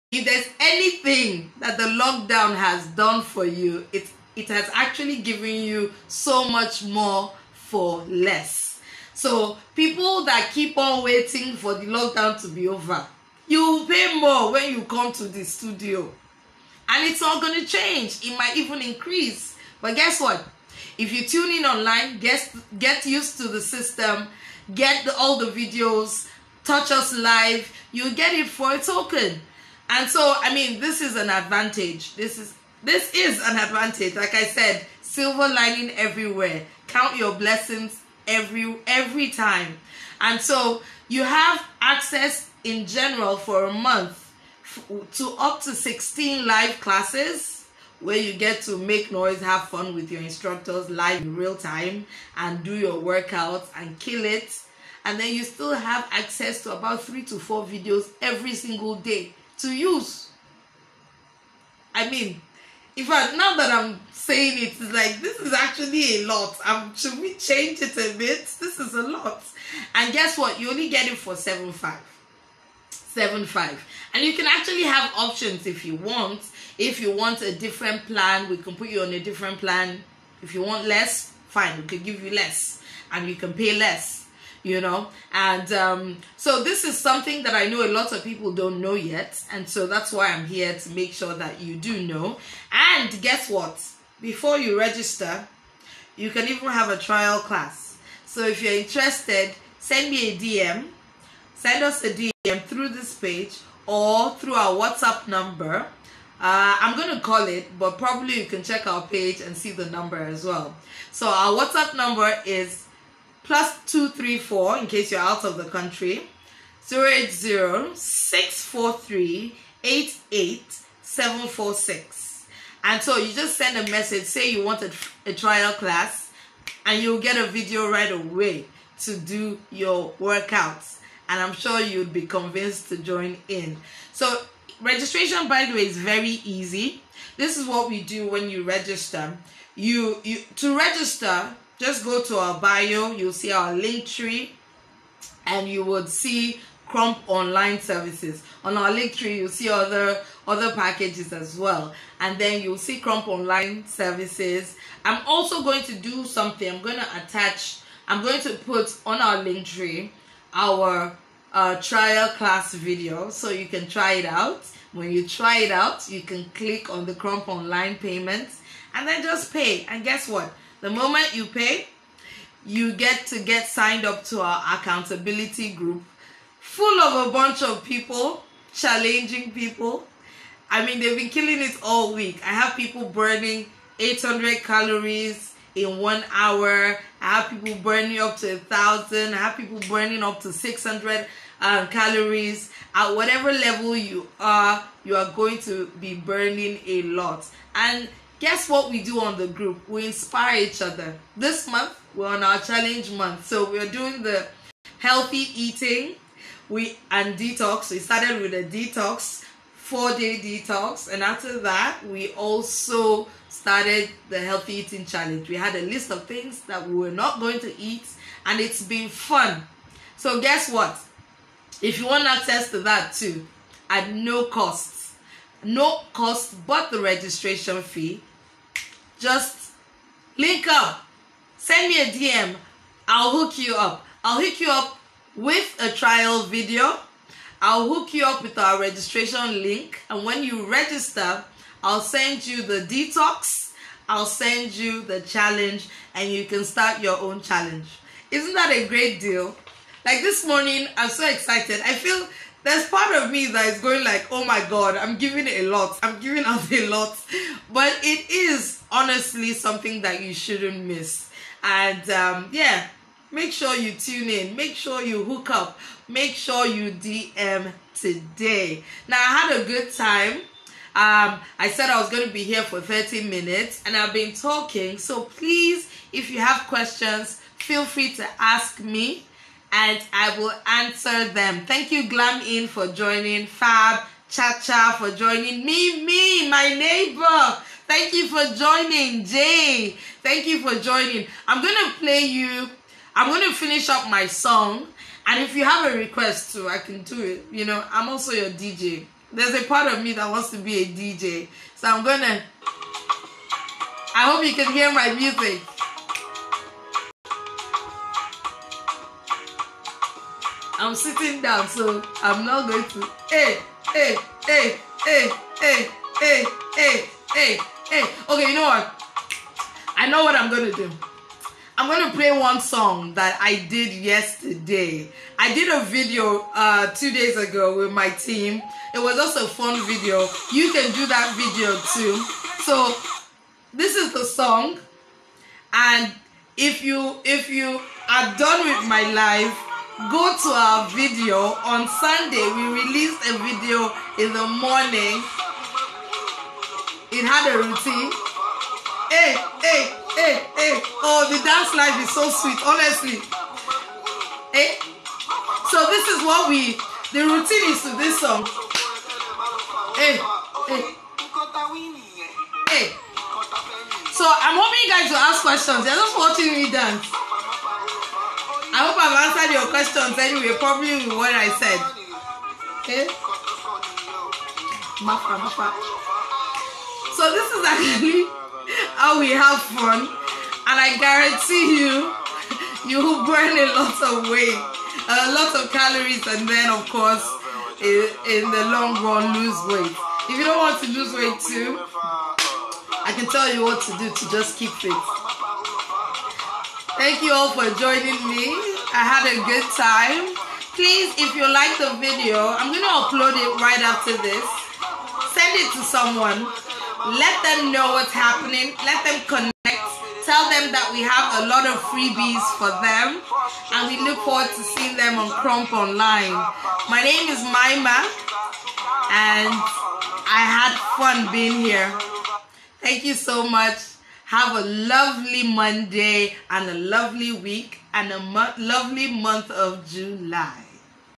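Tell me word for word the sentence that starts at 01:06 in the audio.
Um, should we change it a bit?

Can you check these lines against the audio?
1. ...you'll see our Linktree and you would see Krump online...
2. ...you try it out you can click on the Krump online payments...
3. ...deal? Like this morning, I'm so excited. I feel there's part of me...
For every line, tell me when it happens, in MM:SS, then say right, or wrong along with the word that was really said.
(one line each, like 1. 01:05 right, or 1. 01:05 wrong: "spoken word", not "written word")
1. 02:23 right
2. 02:45 right
3. 04:09 right.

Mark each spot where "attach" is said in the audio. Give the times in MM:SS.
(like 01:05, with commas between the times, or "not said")
02:37.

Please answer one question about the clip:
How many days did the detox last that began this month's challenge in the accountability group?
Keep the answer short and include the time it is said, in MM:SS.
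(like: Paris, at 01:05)
4, at 03:29.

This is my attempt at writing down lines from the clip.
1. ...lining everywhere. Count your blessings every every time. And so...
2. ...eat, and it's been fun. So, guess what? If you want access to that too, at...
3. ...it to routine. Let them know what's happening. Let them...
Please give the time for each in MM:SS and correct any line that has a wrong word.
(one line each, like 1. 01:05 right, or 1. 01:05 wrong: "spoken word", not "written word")
1. 00:35 right
2. 03:37 right
3. 06:45 wrong: "someone", not "routine".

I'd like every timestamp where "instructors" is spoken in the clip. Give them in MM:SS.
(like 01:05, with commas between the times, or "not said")
00:50.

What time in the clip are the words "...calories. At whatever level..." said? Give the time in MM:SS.
03:11.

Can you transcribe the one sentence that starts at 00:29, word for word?
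And so, I mean, this is an advantage.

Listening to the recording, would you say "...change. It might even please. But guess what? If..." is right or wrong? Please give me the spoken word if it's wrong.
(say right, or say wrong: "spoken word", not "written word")
wrong: "increase", not "please".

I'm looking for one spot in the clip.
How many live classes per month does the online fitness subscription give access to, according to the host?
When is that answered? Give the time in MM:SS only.
00:45.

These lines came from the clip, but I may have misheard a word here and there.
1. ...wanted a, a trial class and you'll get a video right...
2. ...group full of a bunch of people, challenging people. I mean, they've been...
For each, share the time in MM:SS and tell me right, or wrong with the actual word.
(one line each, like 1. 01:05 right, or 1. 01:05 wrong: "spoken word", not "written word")
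1. 02:04 right
2. 02:55 right.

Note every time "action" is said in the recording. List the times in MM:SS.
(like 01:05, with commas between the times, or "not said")
not said.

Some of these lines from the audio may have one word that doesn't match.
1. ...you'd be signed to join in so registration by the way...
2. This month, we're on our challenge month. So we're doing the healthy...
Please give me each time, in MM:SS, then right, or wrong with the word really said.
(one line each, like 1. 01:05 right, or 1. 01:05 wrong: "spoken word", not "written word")
1. 02:11 wrong: "convinced", not "signed"
2. 03:21 right.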